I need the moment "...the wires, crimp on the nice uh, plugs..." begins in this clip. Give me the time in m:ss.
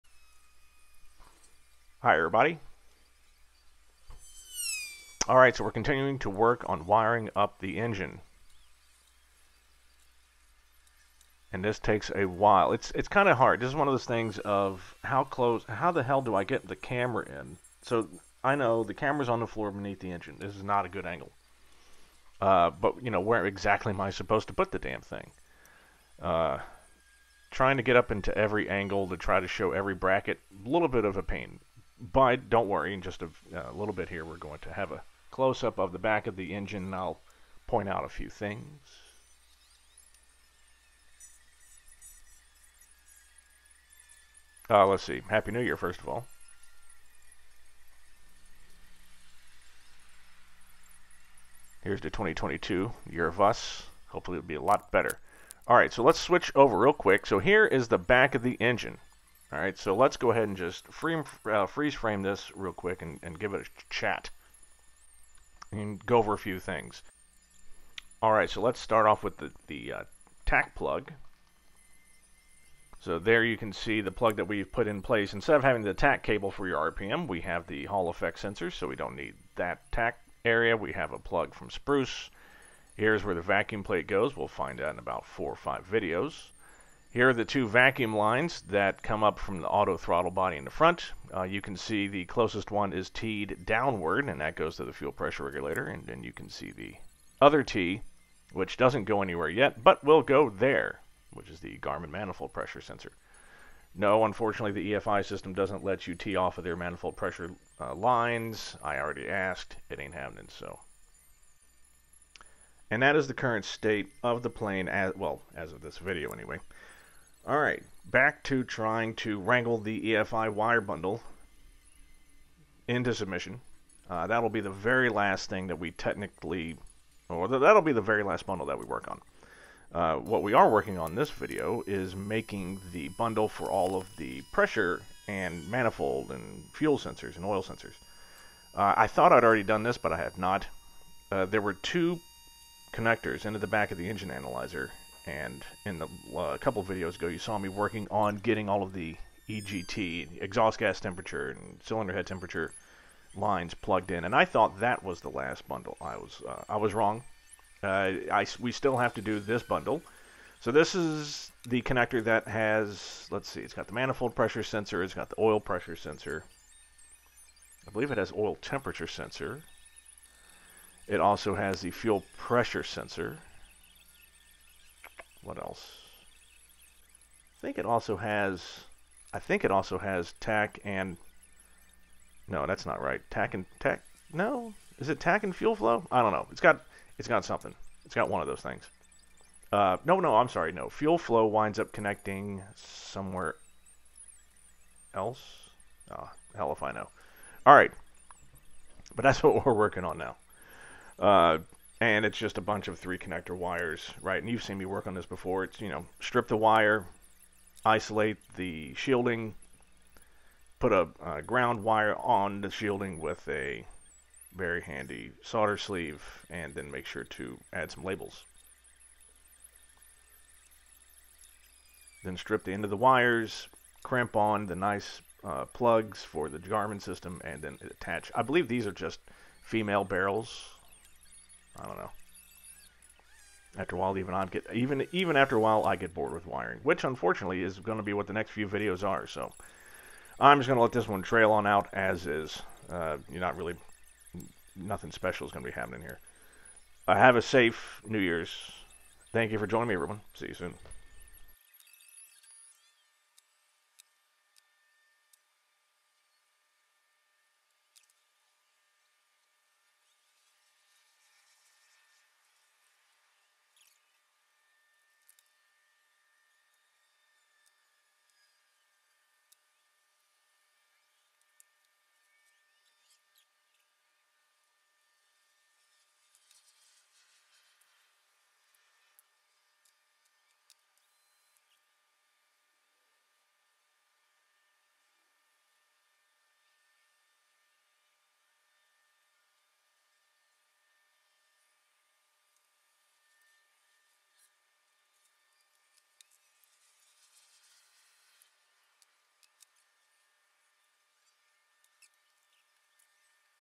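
3:42.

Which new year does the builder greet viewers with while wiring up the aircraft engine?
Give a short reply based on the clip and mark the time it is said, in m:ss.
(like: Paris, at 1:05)
2022, at 0:52.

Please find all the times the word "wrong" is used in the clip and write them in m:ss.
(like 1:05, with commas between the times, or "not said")
2:36.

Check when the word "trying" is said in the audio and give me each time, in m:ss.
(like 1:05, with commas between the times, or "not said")
0:27, 1:58.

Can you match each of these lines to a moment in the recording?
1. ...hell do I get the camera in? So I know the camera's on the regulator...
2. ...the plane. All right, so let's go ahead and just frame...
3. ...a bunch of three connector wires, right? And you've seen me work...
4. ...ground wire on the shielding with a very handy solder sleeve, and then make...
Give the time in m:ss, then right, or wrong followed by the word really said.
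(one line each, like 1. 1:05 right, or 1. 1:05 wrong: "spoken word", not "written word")
1. 0:16 wrong: "floor", not "regulator"
2. 0:58 wrong: "engine", not "plane"
3. 3:22 right
4. 3:31 right.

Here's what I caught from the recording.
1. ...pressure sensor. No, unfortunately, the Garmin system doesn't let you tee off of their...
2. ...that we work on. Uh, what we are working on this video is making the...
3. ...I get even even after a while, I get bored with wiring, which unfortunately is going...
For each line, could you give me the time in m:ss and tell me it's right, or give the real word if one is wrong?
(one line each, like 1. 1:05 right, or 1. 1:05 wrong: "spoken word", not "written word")
1. 1:42 wrong: "EFI", not "Garmin"
2. 2:08 right
3. 3:54 right.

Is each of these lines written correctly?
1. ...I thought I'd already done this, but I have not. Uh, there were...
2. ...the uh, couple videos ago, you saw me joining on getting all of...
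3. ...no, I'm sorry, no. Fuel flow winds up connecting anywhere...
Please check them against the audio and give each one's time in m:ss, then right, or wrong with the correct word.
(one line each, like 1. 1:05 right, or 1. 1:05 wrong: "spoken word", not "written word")
1. 2:18 right
2. 2:25 wrong: "working", not "joining"
3. 3:10 wrong: "somewhere", not "anywhere".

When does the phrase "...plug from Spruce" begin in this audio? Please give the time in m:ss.
1:21.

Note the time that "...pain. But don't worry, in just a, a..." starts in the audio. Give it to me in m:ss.
0:31.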